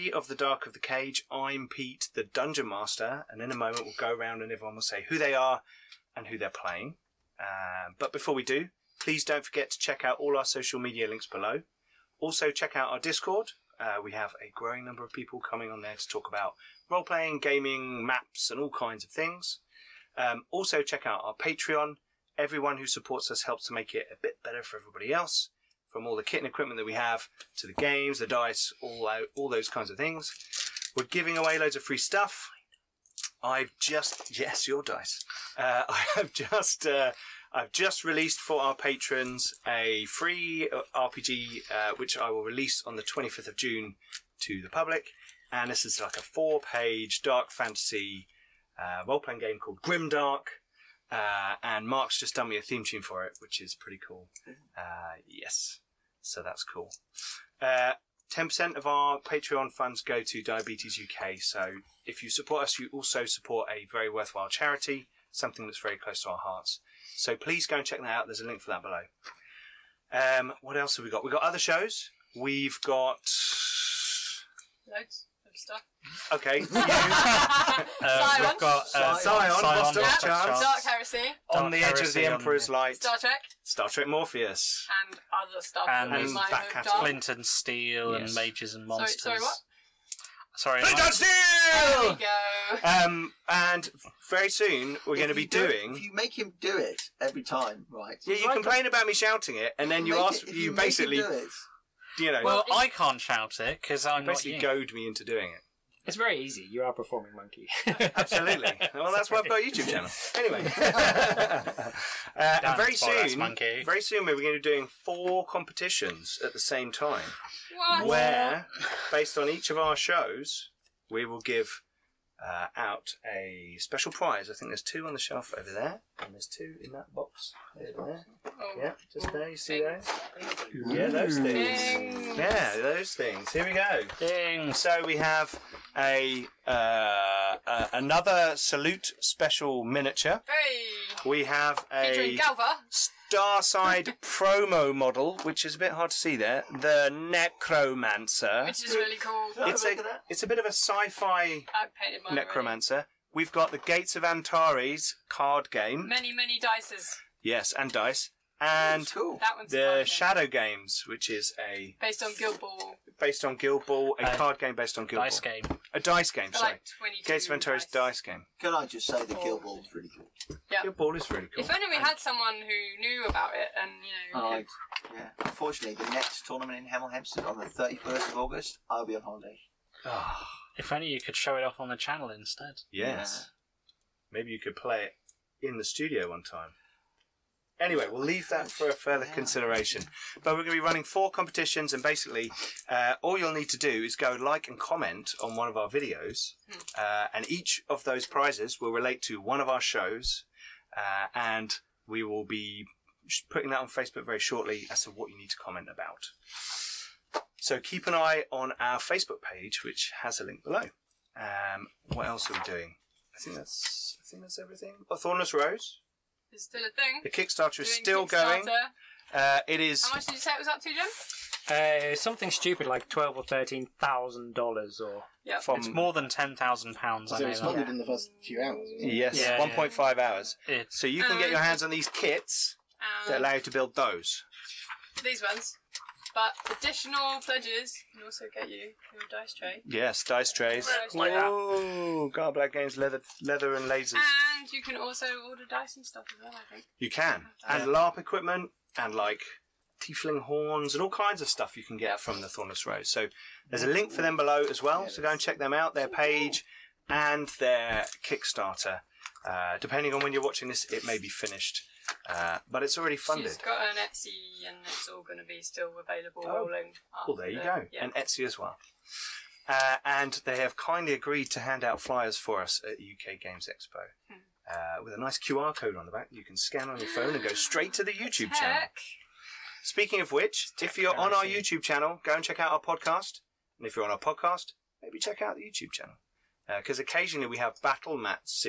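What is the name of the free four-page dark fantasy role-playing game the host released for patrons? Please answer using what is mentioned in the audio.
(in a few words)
Grimdark.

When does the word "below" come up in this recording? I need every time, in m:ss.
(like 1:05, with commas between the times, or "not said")
0:11, 1:08, 3:30, 4:14.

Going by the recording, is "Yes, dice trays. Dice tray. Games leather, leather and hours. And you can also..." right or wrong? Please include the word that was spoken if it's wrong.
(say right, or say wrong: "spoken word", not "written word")
wrong: "lasers", not "hours".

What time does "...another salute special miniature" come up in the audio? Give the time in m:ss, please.
2:17.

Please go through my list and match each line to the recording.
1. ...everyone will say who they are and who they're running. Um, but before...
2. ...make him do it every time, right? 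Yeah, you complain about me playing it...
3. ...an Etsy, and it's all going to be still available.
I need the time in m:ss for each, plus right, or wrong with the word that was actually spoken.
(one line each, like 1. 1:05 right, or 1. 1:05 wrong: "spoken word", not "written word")
1. 0:04 wrong: "playing", not "running"
2. 1:36 wrong: "shouting", not "playing"
3. 4:23 right.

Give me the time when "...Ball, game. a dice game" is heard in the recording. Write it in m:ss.
2:45.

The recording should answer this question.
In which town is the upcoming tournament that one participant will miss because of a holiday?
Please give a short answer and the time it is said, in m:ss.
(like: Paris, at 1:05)
Hemel Hempstead, at 2:56.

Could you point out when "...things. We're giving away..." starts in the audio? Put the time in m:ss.
0:29.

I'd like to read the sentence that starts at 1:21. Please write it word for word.
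on the Edge of the Emperor's Light.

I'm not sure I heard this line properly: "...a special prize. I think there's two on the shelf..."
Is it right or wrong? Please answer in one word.
right.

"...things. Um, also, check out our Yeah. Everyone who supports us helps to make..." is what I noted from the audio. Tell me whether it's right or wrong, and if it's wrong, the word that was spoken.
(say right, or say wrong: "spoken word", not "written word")
wrong: "Patreon", not "Yeah".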